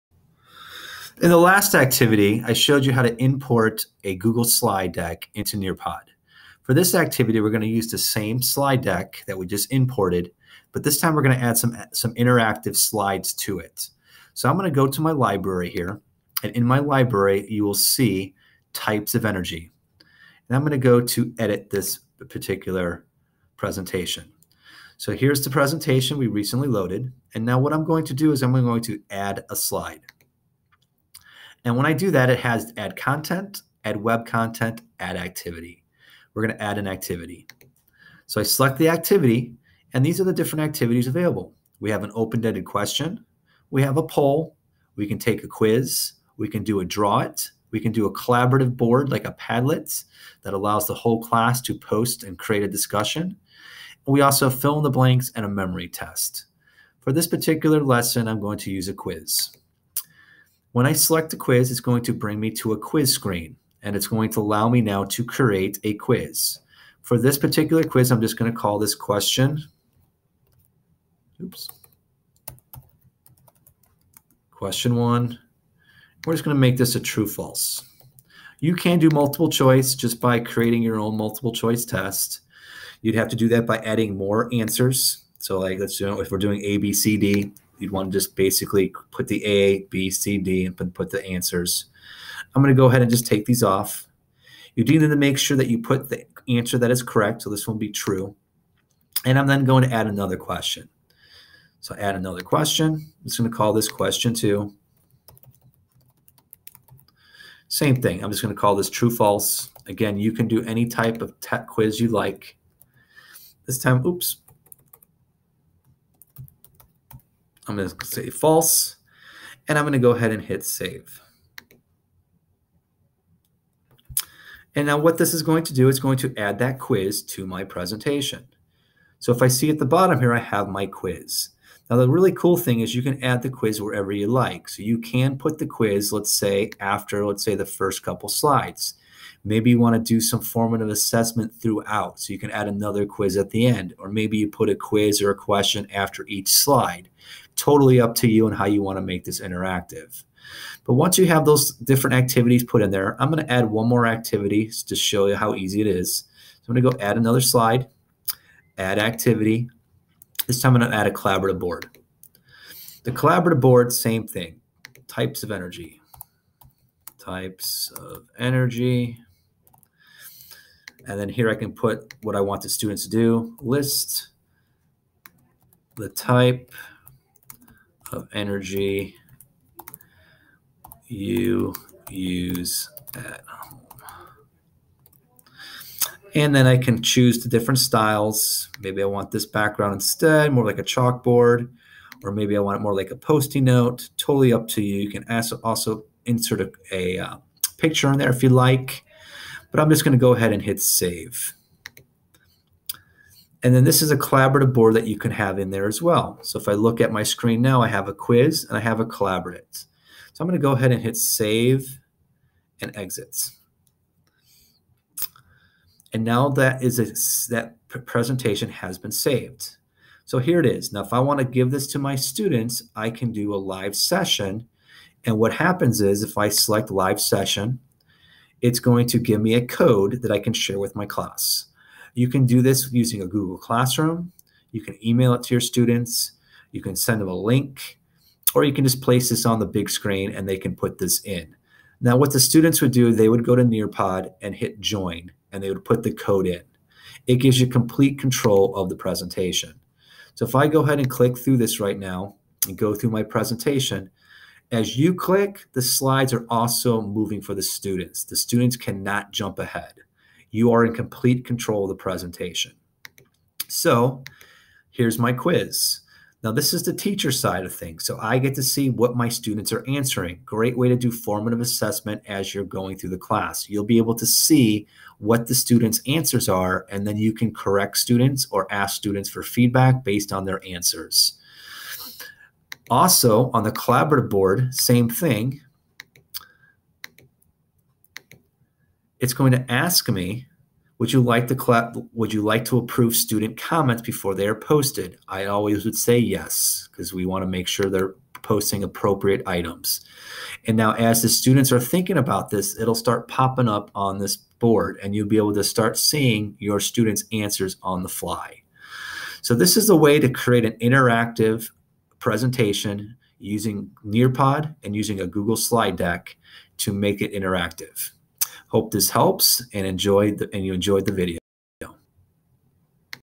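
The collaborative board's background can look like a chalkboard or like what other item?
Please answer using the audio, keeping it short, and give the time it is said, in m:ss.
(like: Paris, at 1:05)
Post-it note, at 3:13.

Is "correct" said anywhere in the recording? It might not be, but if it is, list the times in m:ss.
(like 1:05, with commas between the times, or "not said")
1:37, 4:37.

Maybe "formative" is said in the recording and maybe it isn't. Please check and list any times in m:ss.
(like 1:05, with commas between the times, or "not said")
2:20, 4:31.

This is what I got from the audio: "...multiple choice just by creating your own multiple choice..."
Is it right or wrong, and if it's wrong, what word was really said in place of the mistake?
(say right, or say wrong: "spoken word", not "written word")
right.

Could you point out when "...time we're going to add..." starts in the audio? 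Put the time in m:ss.
0:10.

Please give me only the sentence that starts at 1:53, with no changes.
This time, oops, I'm going to say false, and I'm going to go ahead and hit save.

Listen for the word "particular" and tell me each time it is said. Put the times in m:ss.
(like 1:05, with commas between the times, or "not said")
0:22, 0:57, 1:07.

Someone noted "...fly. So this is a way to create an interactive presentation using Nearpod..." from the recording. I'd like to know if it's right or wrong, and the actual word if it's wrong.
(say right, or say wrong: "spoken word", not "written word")
right.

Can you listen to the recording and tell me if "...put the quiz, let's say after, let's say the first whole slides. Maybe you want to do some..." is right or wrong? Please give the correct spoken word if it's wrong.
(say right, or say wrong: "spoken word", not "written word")
wrong: "couple", not "whole".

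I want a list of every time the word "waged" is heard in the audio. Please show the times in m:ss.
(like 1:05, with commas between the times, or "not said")
not said.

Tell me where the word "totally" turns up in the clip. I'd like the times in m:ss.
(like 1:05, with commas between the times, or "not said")
2:27, 3:14.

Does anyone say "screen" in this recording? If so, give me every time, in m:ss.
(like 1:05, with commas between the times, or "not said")
1:03, 3:27, 3:59.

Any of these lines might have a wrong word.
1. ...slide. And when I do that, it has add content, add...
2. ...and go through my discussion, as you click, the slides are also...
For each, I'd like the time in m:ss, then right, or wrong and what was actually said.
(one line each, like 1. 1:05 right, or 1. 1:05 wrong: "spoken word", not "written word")
1. 0:29 right
2. 4:12 wrong: "presentation", not "discussion".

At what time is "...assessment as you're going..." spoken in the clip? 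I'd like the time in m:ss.
4:31.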